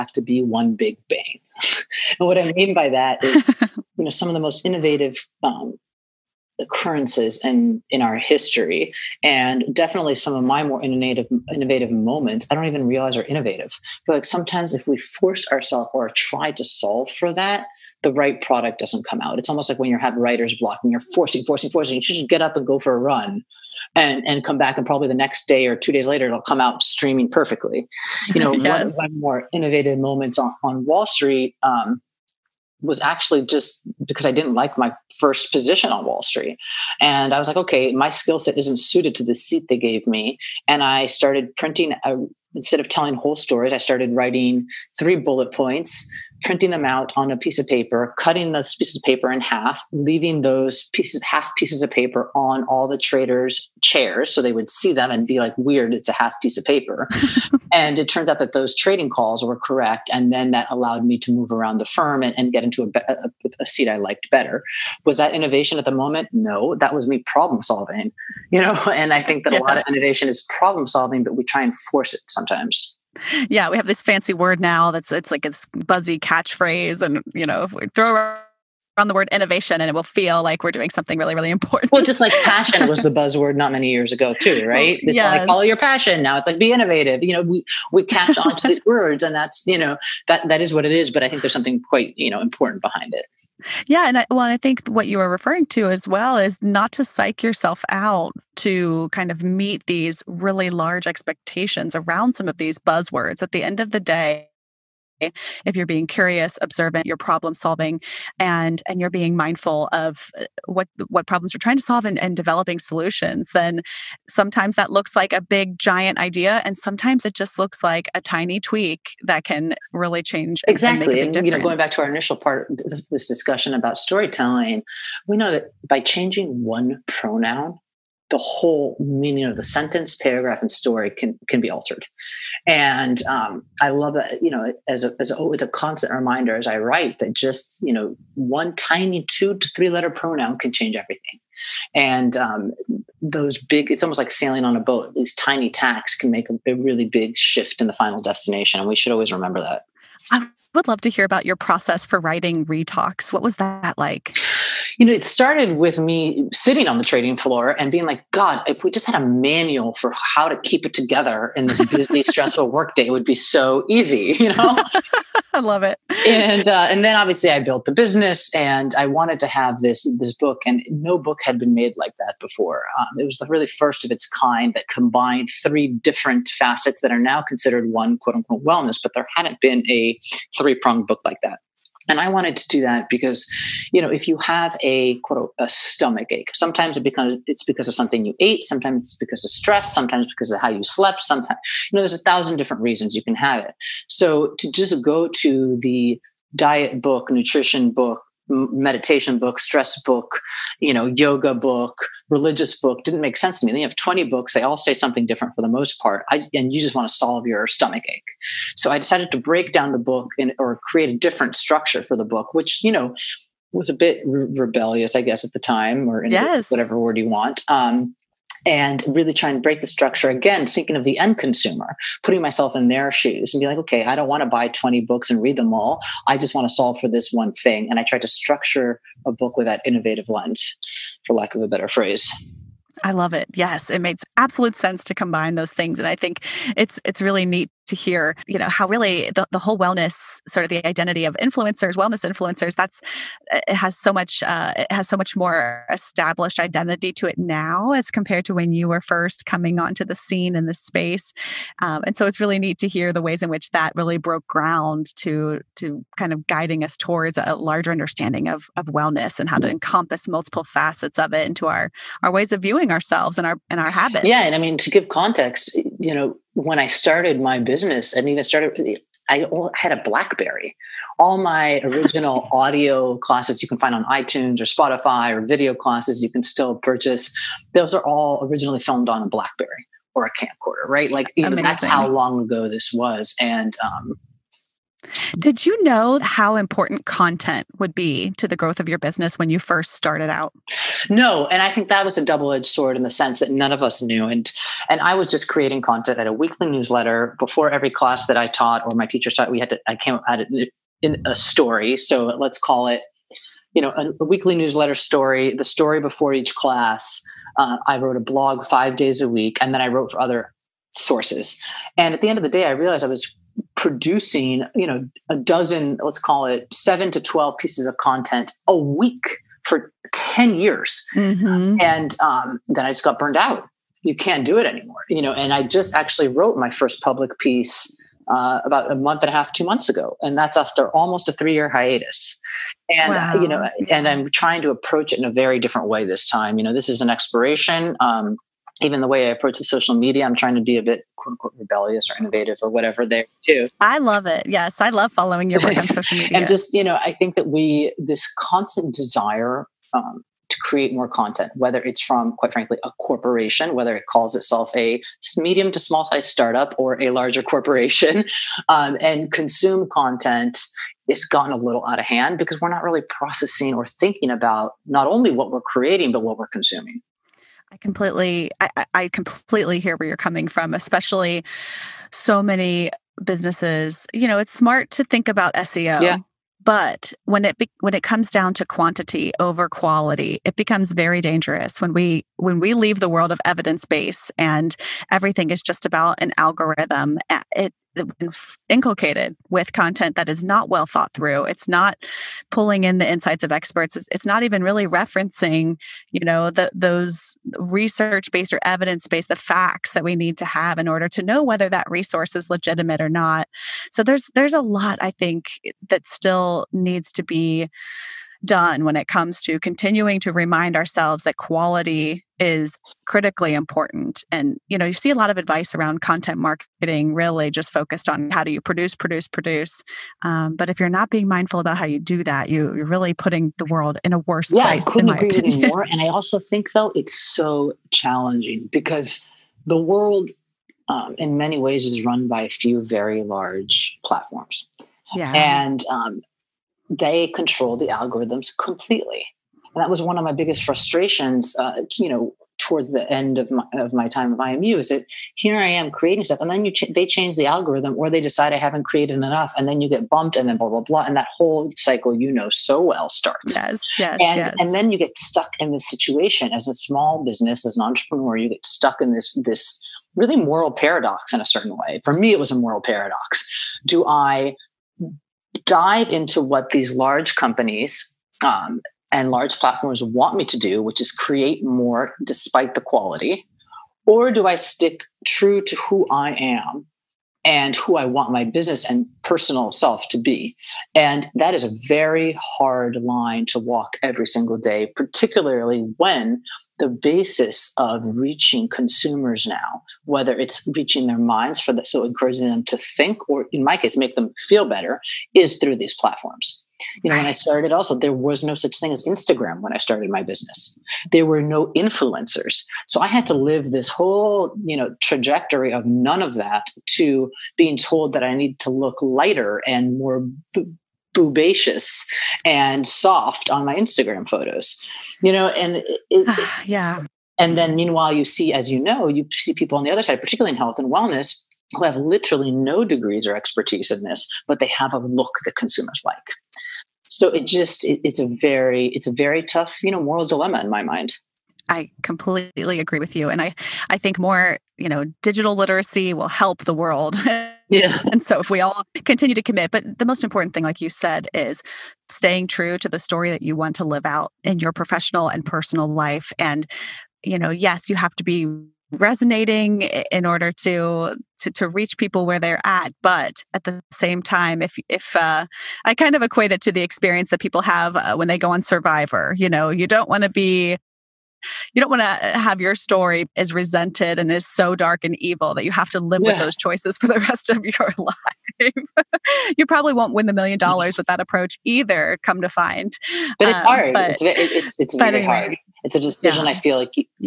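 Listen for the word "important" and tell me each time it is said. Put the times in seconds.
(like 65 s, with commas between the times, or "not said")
81 s, 92 s, 286 s, 413 s, 540 s.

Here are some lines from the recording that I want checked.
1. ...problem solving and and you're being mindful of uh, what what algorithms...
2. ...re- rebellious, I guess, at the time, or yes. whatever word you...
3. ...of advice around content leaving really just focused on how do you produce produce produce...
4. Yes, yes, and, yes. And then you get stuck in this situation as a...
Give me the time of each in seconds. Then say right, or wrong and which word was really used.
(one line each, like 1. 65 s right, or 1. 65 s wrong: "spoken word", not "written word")
1. 107 s wrong: "problems", not "algorithms"
2. 214 s right
3. 415 s wrong: "marketing", not "leaving"
4. 453 s right.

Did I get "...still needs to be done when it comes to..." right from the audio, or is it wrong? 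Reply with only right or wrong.
right.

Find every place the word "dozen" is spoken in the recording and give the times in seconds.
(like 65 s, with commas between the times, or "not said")
315 s.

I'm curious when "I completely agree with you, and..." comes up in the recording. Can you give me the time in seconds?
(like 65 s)
531 s.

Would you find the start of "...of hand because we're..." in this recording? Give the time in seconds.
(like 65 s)
362 s.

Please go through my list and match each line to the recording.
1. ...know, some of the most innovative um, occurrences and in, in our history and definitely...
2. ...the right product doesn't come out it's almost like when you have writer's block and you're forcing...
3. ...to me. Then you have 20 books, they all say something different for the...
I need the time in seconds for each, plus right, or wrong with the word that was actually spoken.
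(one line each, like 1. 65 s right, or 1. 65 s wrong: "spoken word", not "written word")
1. 4 s right
2. 18 s right
3. 203 s right.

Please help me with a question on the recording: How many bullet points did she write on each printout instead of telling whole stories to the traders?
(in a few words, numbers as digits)
3.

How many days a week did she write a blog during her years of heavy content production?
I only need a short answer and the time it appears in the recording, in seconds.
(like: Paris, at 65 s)
5, at 308 s.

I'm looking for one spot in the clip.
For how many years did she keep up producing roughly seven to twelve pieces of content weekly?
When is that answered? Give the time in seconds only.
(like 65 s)
320 s.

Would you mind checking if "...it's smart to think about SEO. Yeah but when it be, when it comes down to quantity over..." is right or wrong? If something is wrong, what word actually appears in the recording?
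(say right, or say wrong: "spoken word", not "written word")
right.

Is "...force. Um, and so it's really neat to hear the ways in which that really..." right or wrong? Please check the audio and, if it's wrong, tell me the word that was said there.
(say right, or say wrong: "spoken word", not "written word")
wrong: "space", not "force".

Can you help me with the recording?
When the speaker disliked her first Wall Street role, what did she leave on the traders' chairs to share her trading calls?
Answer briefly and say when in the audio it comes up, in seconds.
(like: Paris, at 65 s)
Half pieces of paper, at 51 s.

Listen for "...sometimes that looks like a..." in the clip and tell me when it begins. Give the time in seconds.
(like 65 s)
114 s.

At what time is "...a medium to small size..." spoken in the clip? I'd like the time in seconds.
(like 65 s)
354 s.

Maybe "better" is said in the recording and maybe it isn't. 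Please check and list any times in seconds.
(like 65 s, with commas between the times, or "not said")
64 s, 231 s, 494 s.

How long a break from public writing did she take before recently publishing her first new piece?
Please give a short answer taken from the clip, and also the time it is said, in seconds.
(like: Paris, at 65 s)
Almost 3 years, at 330 s.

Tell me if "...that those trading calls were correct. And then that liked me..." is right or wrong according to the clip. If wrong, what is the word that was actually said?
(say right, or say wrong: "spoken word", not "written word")
wrong: "allowed", not "liked".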